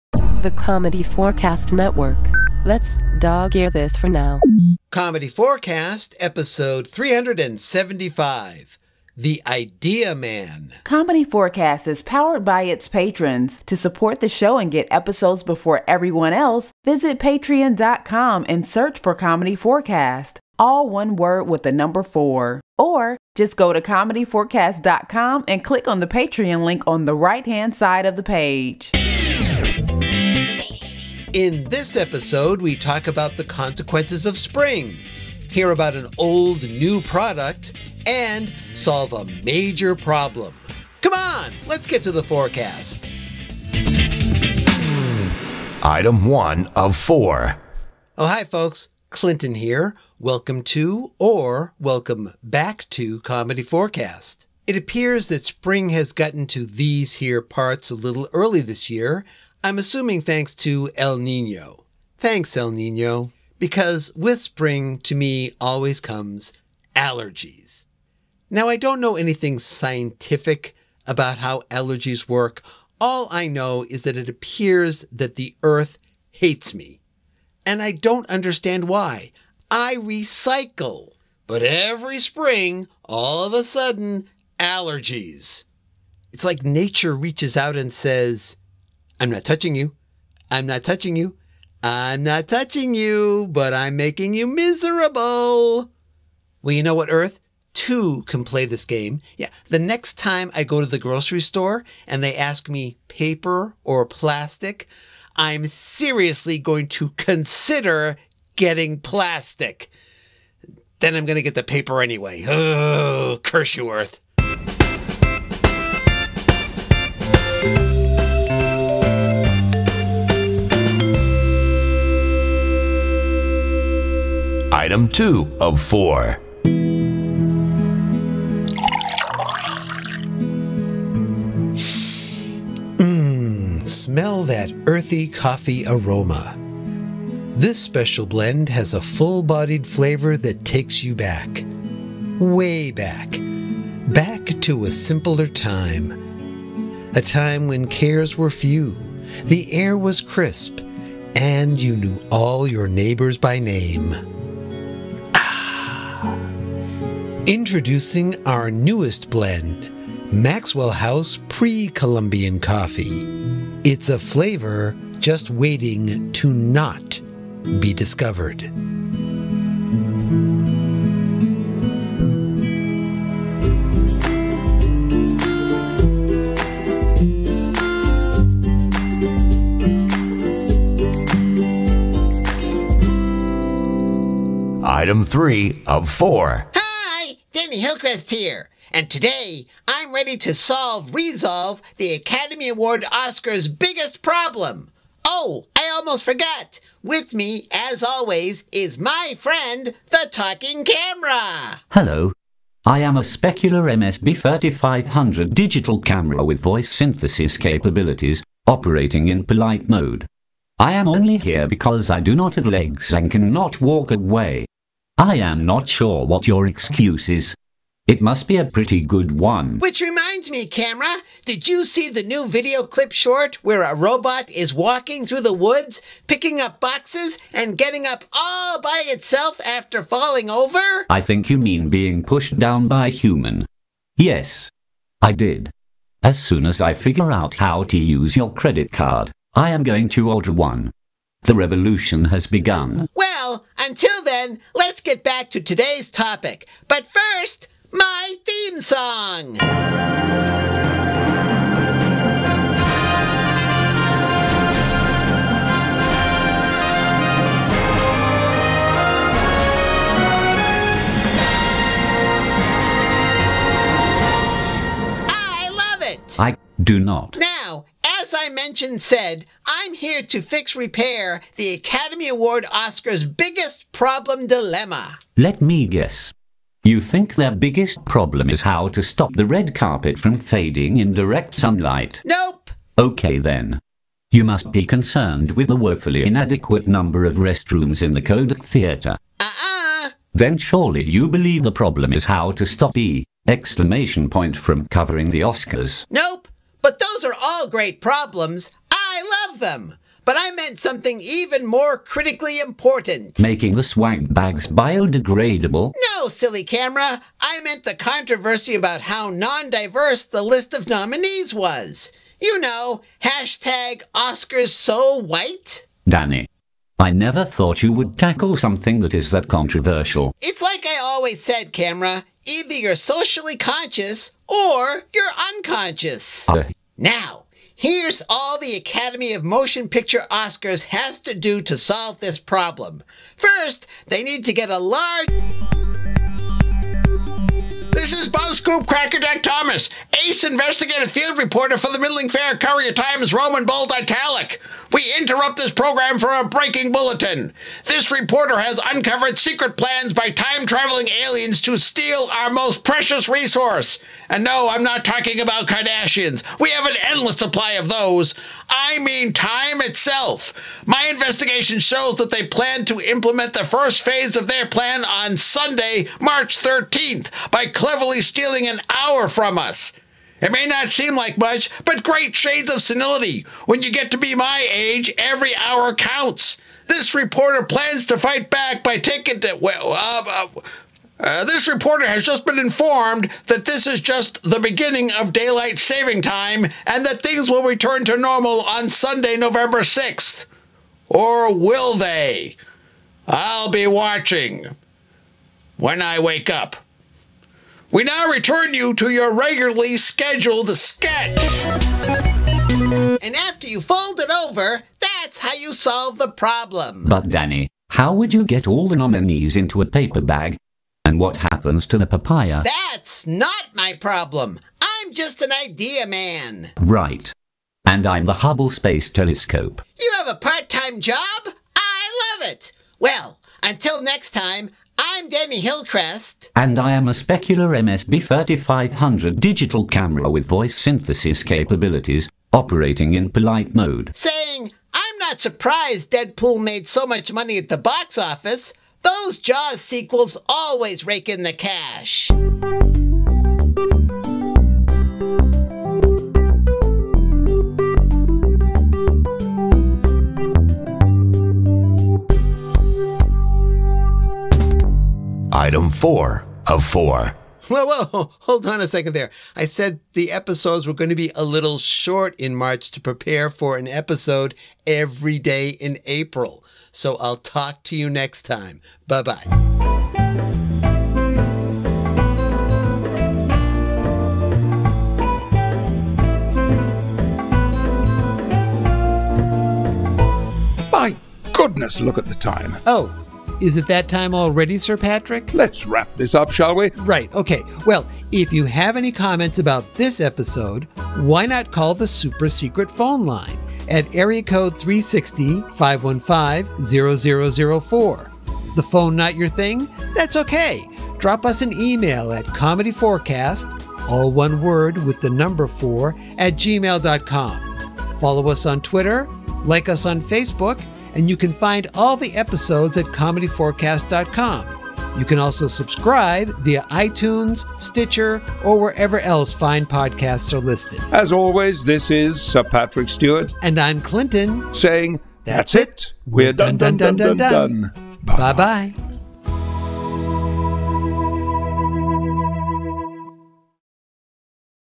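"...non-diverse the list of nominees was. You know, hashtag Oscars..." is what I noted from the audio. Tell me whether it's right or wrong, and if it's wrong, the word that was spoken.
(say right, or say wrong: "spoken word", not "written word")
right.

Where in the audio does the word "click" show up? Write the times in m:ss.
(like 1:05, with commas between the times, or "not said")
0:25.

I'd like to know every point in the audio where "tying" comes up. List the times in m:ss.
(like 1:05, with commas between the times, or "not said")
not said.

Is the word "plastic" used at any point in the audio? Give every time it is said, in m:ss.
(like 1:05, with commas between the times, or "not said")
1:44, 1:49.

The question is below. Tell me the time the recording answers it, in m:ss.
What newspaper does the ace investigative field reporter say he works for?
5:41.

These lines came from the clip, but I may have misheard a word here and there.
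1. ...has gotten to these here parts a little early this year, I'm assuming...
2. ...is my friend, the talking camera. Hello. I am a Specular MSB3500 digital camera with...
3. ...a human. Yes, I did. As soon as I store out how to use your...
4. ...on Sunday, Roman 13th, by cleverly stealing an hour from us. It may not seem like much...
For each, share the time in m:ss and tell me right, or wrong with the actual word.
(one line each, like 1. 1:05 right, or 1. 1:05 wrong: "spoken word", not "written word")
1. 0:55 right
2. 3:18 right
3. 3:53 wrong: "figure", not "store"
4. 6:05 wrong: "March", not "Roman".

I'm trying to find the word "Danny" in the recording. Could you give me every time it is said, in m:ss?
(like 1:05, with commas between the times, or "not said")
3:07, 5:16, 6:47, 7:05.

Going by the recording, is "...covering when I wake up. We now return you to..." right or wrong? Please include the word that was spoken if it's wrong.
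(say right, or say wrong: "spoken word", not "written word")
wrong: "watching", not "covering".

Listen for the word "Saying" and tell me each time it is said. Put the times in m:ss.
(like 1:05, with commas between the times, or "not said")
7:14, 8:44.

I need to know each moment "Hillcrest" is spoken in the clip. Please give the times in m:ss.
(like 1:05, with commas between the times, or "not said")
3:07, 7:05.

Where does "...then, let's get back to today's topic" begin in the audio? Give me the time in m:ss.
4:04.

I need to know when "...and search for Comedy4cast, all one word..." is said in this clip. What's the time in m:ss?
0:18.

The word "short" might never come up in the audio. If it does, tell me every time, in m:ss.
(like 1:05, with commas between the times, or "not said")
3:43, 7:41.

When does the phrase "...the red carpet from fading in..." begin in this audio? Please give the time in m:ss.
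4:39.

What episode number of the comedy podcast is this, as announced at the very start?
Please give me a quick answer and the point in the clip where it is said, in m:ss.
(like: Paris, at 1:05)
375, at 0:06.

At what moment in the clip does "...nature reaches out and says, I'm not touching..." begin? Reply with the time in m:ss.
1:26.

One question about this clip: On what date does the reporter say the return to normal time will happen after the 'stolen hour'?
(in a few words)
November 6th.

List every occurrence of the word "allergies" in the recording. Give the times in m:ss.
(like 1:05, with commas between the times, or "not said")
1:06, 1:11, 1:24.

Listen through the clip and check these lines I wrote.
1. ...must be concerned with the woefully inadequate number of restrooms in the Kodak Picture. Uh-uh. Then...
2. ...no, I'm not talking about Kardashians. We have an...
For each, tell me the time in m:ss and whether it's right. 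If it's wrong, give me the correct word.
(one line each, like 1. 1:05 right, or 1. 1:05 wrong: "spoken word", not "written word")
1. 4:44 wrong: "Theatre", not "Picture"
2. 5:54 right.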